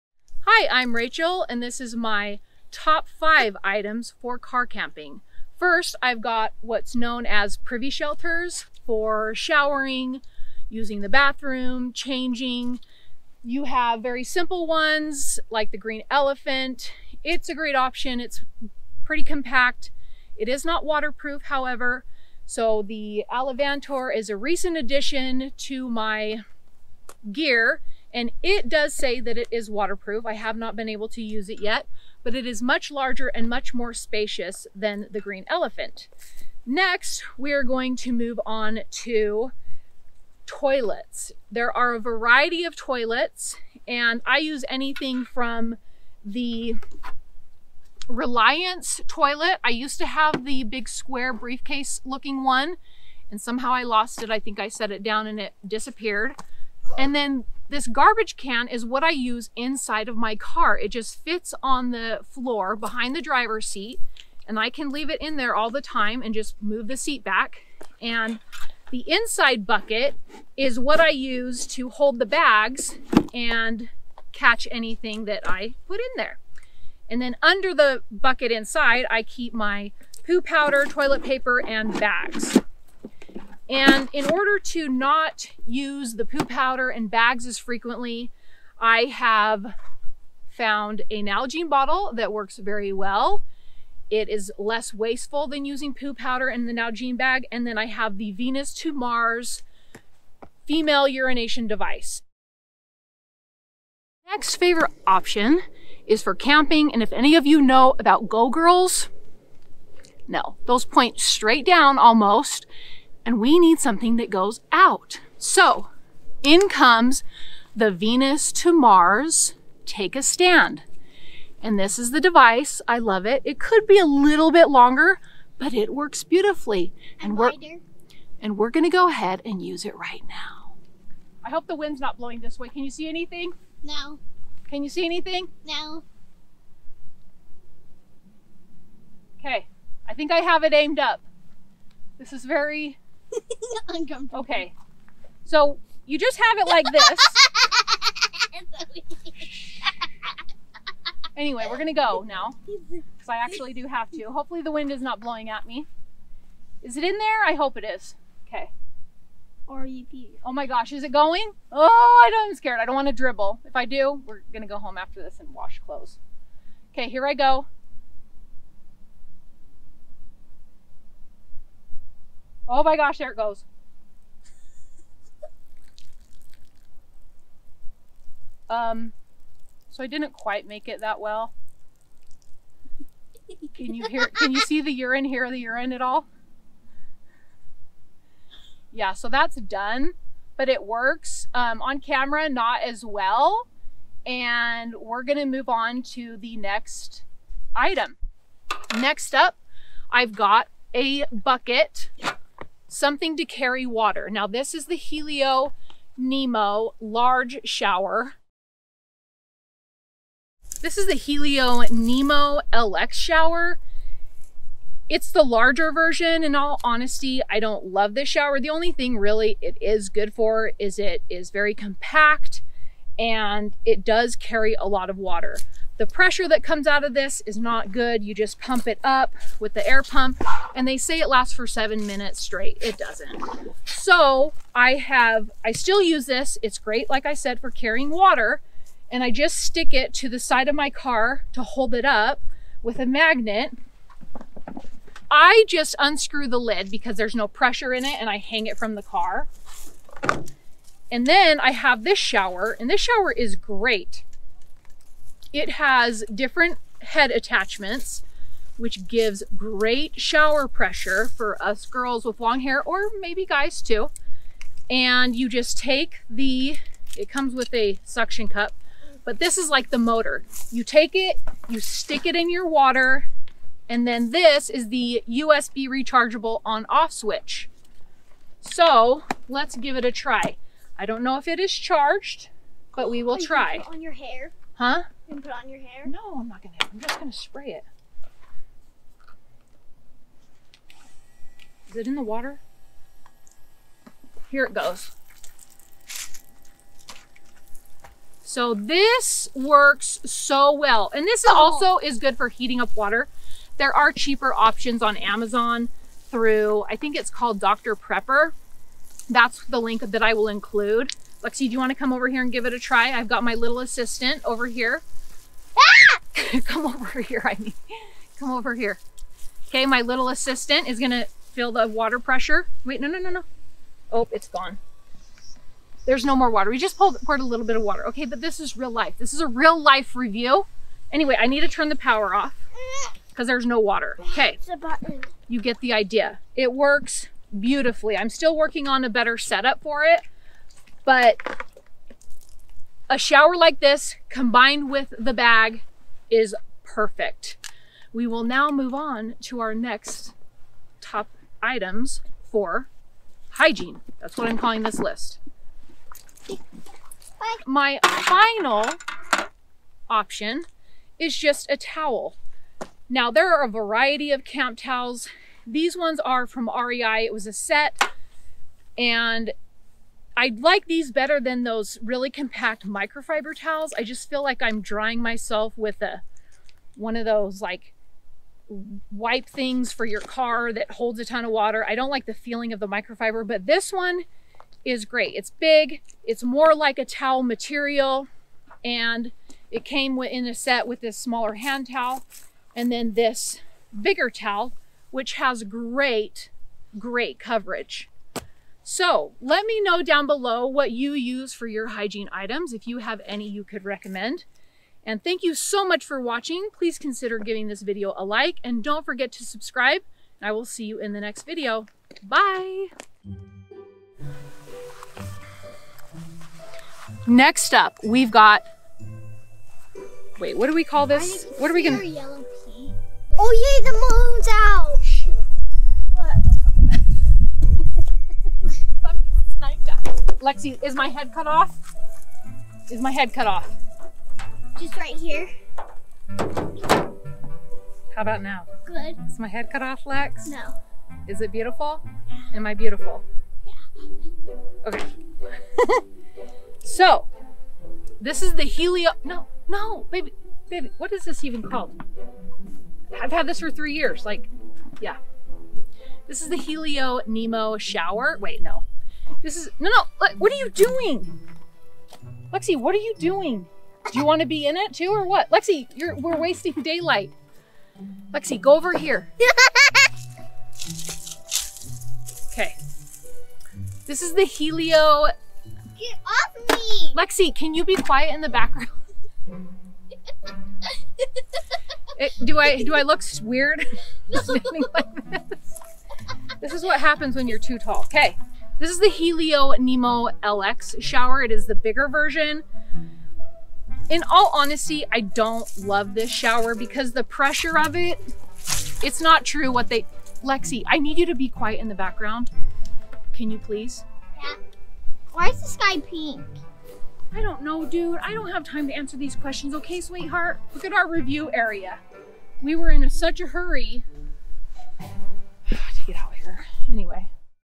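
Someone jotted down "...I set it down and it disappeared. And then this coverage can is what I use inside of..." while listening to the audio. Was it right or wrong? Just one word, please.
wrong.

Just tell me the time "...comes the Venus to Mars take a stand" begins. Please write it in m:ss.
1:56.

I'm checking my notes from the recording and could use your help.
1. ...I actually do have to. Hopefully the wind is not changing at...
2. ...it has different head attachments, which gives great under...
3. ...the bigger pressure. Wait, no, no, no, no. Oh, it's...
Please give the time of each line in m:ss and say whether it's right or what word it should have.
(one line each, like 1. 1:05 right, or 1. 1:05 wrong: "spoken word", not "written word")
1. 2:33 wrong: "blowing", not "changing"
2. 4:15 wrong: "shower", not "under"
3. 5:21 wrong: "water", not "bigger".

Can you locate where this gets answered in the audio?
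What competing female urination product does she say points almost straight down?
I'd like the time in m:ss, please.
1:48.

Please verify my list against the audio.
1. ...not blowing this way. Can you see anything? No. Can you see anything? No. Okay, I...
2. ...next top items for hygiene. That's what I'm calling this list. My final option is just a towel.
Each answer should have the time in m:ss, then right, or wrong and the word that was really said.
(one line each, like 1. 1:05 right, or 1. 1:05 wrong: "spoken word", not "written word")
1. 2:12 right
2. 5:49 right.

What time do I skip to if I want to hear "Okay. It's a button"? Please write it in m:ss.
5:34.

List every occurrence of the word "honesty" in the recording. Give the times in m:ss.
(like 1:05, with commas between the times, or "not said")
3:36, 8:14.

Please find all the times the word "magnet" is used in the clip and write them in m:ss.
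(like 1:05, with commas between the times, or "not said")
4:03.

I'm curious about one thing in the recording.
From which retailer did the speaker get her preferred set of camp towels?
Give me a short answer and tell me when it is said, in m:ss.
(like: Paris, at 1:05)
REI, at 6:06.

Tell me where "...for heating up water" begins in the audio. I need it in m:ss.
5:02.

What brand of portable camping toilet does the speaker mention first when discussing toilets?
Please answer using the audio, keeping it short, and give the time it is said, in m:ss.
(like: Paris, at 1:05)
Reliance, at 0:48.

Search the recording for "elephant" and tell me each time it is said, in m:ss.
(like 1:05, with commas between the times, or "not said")
0:16, 0:35.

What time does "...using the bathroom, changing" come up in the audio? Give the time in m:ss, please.
0:10.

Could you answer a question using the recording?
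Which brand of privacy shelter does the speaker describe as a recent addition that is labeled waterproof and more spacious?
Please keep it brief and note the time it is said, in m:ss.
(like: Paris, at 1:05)
Alvantor, at 0:23.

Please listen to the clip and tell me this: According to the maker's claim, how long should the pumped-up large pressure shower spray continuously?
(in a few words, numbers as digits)
7 minutes.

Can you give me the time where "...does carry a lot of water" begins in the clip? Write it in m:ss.
3:44.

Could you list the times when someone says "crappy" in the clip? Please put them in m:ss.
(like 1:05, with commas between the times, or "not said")
not said.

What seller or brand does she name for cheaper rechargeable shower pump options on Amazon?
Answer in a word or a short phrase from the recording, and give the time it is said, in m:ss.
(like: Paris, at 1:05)
Dr. 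Prepper, at 5:07.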